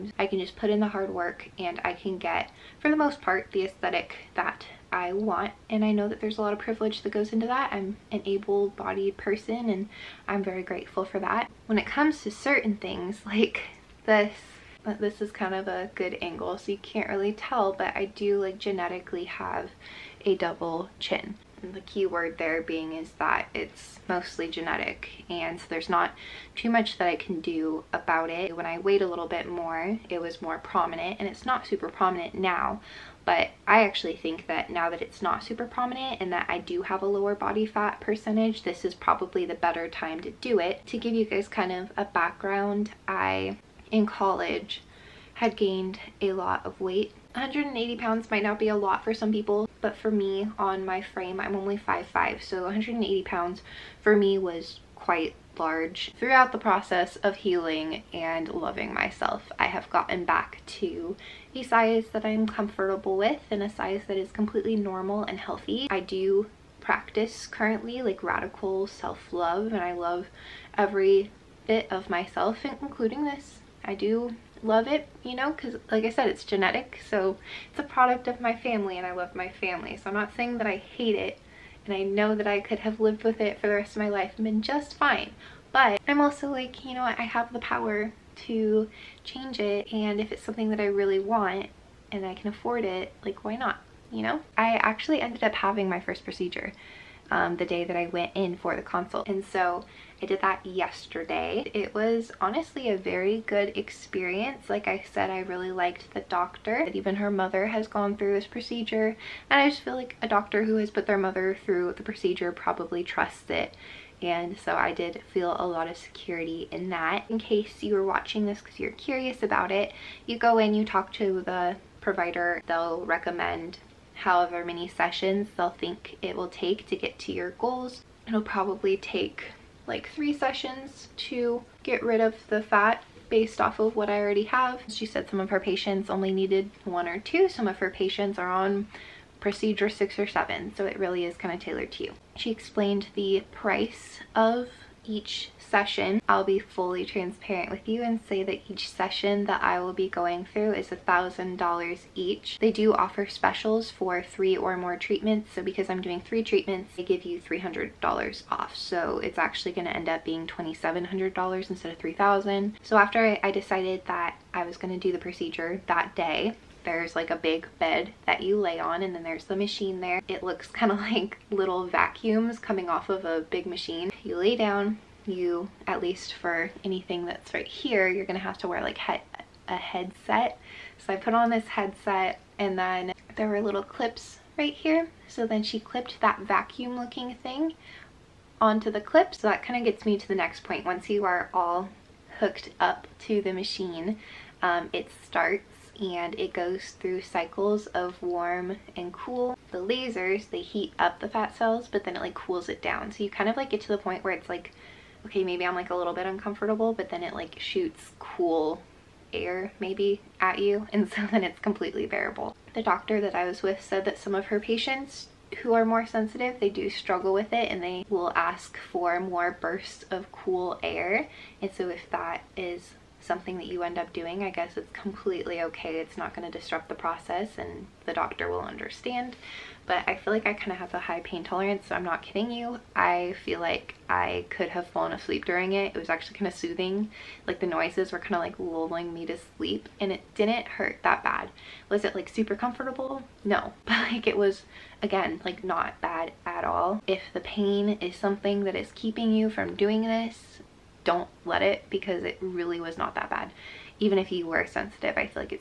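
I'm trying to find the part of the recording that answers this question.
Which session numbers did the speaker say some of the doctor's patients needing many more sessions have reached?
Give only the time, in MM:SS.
02:19.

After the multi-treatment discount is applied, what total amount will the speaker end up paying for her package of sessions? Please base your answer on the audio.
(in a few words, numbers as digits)
$2,700.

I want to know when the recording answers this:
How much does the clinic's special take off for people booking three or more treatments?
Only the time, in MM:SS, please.
02:37.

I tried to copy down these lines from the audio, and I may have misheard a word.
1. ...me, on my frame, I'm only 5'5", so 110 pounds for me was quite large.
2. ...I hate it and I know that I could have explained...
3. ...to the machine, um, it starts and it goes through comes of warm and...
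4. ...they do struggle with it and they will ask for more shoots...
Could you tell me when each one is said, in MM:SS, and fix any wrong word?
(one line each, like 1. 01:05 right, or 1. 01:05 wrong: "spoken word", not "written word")
1. 00:50 wrong: "180", not "110"
2. 01:20 wrong: "lived", not "explained"
3. 03:13 wrong: "cycles", not "comes"
4. 03:36 wrong: "bursts", not "shoots".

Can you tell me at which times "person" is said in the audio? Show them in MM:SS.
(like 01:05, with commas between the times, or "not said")
00:09.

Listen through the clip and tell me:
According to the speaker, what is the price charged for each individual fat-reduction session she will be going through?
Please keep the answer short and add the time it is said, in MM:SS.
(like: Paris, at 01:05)
$1,000, at 02:30.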